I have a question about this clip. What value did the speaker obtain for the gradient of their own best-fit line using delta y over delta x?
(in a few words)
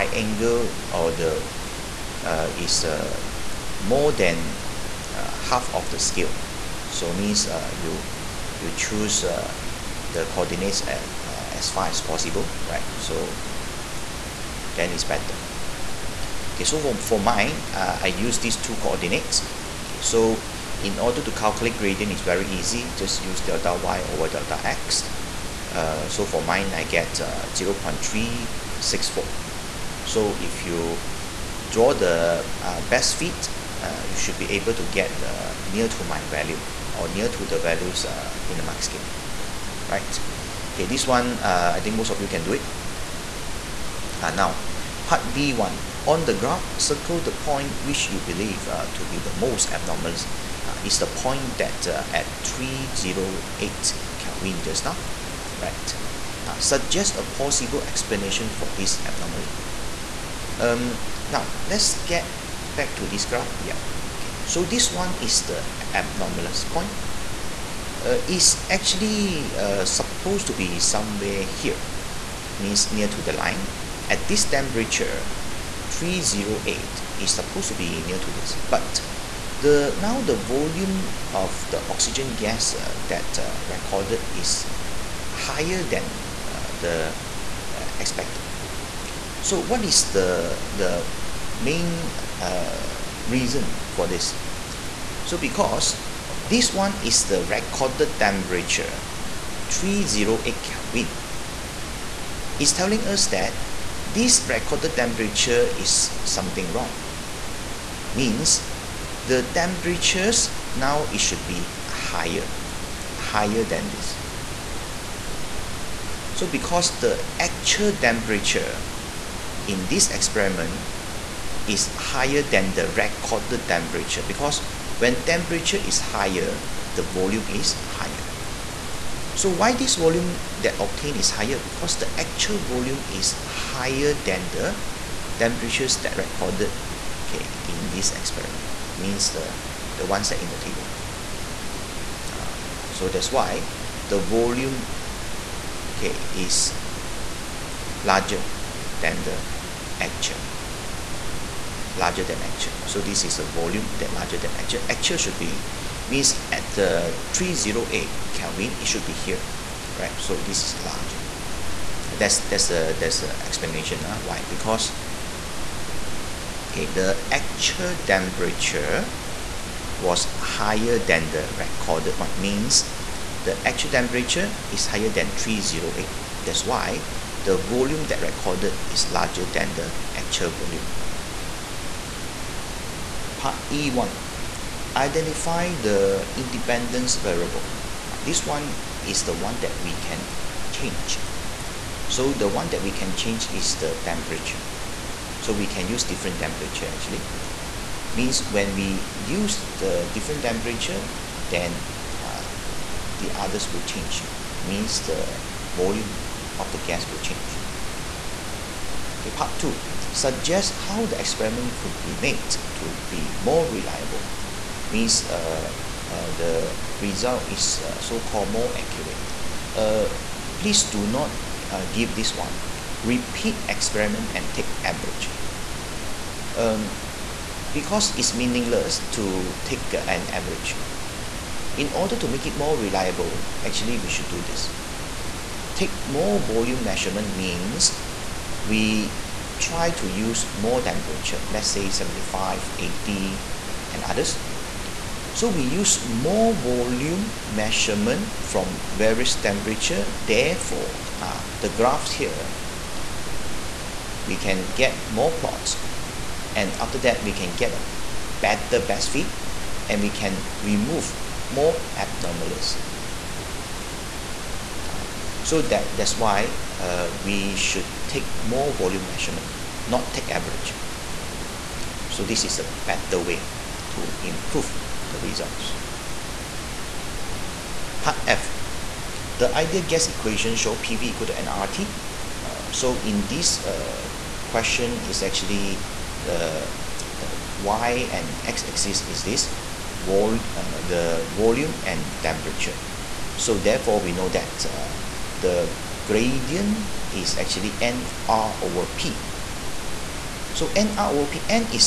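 0.364.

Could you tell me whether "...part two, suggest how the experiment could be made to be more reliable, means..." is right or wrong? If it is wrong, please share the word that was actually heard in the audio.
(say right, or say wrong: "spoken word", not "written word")
right.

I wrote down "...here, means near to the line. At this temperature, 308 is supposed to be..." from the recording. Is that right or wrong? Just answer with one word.
right.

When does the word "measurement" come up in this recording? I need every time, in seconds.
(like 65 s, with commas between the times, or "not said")
236 s, 247 s, 269 s.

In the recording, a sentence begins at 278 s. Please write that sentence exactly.
Part F, the ideal gas equation show PV equal to nRT.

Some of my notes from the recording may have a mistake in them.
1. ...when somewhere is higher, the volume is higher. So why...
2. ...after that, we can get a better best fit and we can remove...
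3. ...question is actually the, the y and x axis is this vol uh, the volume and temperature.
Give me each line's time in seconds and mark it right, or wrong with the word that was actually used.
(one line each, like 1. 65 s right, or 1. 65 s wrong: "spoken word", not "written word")
1. 124 s wrong: "temperature", not "somewhere"
2. 256 s right
3. 284 s right.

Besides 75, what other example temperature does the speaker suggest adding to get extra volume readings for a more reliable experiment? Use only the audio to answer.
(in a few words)
80.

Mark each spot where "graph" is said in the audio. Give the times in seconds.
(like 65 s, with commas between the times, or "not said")
46 s, 63 s, 251 s.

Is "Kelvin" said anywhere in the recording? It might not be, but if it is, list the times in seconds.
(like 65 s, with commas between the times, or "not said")
54 s, 100 s, 158 s.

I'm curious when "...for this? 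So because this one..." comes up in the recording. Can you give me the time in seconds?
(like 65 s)
93 s.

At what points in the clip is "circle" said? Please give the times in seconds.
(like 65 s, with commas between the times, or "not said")
46 s.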